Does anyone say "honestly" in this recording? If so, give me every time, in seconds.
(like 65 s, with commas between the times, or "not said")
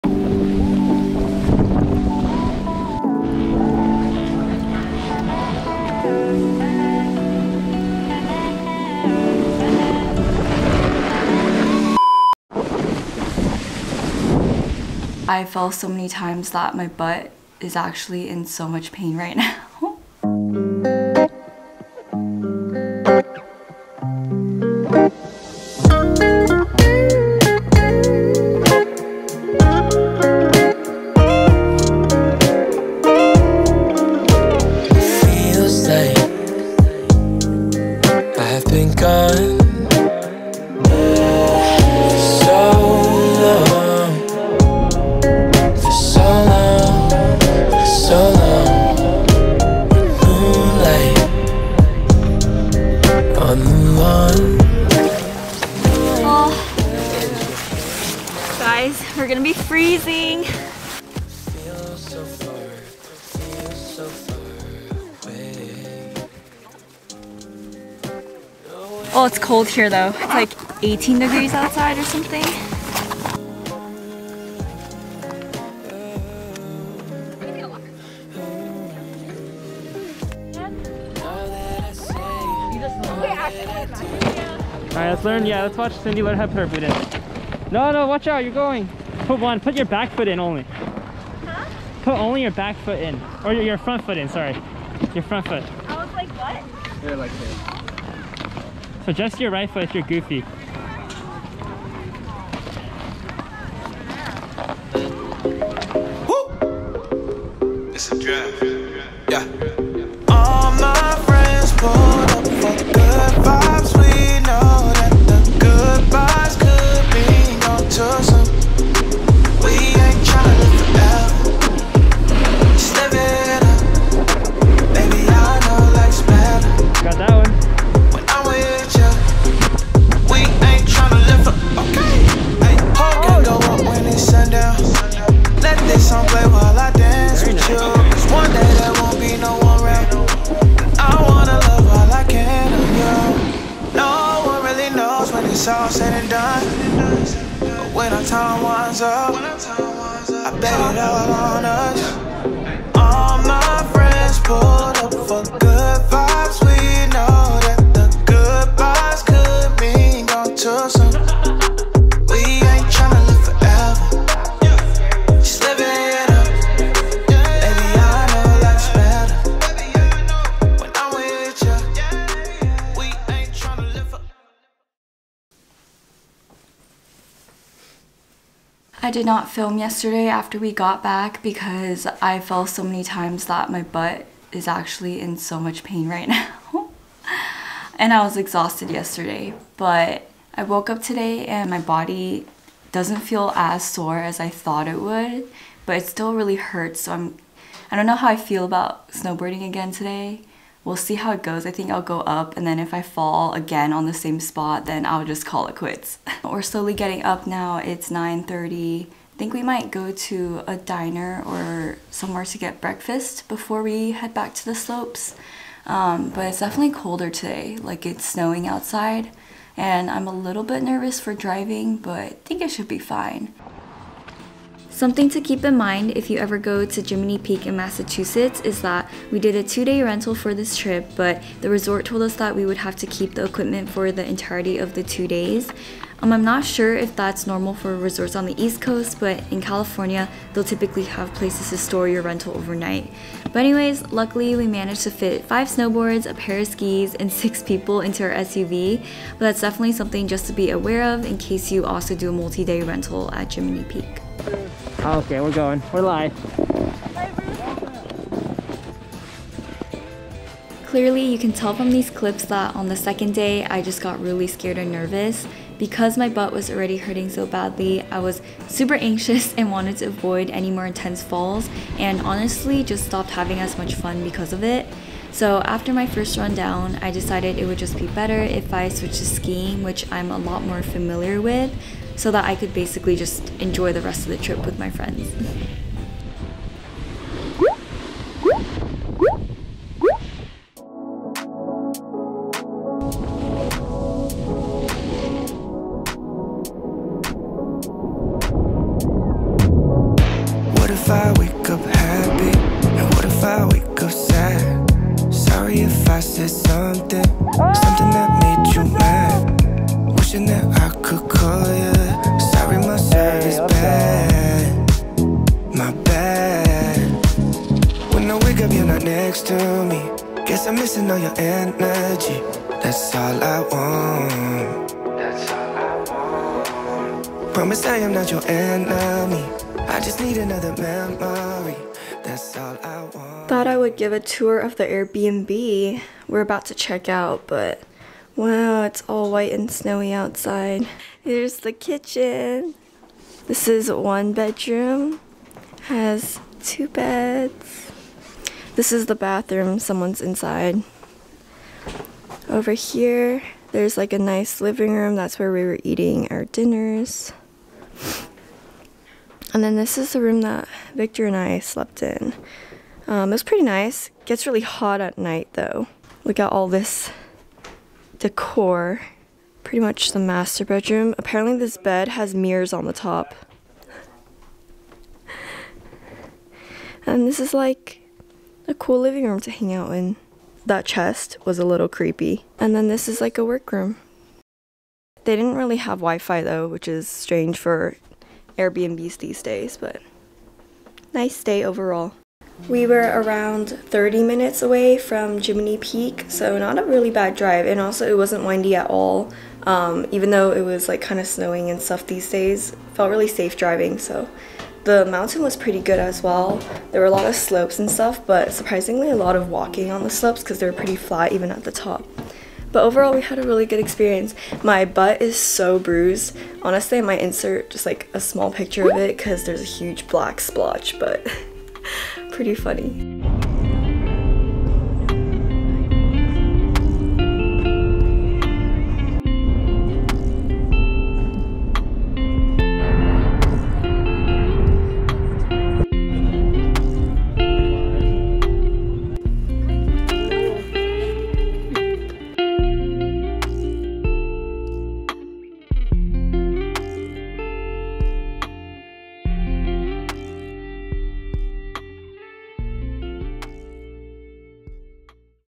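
272 s, 416 s.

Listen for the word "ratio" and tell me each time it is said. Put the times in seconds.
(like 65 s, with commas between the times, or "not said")
not said.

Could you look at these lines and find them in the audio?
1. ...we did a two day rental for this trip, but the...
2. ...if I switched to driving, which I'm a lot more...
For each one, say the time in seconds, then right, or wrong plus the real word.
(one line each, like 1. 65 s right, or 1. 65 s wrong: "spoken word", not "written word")
1. 229 s right
2. 278 s wrong: "skiing", not "driving".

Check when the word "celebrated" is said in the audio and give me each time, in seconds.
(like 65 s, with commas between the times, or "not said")
not said.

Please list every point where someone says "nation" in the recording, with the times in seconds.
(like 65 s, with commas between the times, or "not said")
not said.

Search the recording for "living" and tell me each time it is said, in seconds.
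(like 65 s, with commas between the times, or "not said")
354 s, 378 s.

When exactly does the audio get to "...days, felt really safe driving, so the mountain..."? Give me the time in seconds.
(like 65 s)
402 s.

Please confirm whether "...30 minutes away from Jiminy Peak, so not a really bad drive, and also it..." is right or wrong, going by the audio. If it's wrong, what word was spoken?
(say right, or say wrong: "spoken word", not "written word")
right.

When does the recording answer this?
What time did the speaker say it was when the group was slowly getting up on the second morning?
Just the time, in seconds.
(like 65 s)
208 s.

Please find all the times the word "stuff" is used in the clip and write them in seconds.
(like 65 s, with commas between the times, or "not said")
401 s, 407 s.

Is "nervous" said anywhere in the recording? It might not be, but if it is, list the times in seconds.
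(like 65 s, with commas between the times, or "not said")
220 s, 264 s.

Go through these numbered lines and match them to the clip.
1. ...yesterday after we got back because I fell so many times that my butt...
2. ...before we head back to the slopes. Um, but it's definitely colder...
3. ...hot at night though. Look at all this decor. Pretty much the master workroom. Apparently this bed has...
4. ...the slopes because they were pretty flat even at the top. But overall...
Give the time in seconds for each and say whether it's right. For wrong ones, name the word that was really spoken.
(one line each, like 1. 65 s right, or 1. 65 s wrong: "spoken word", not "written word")
1. 179 s right
2. 213 s right
3. 364 s wrong: "bedroom", not "workroom"
4. 410 s right.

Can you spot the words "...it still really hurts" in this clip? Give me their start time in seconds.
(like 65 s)
195 s.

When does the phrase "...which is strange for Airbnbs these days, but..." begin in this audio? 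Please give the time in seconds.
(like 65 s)
386 s.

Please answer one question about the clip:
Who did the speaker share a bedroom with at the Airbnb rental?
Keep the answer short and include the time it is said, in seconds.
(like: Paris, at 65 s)
Victor, at 360 s.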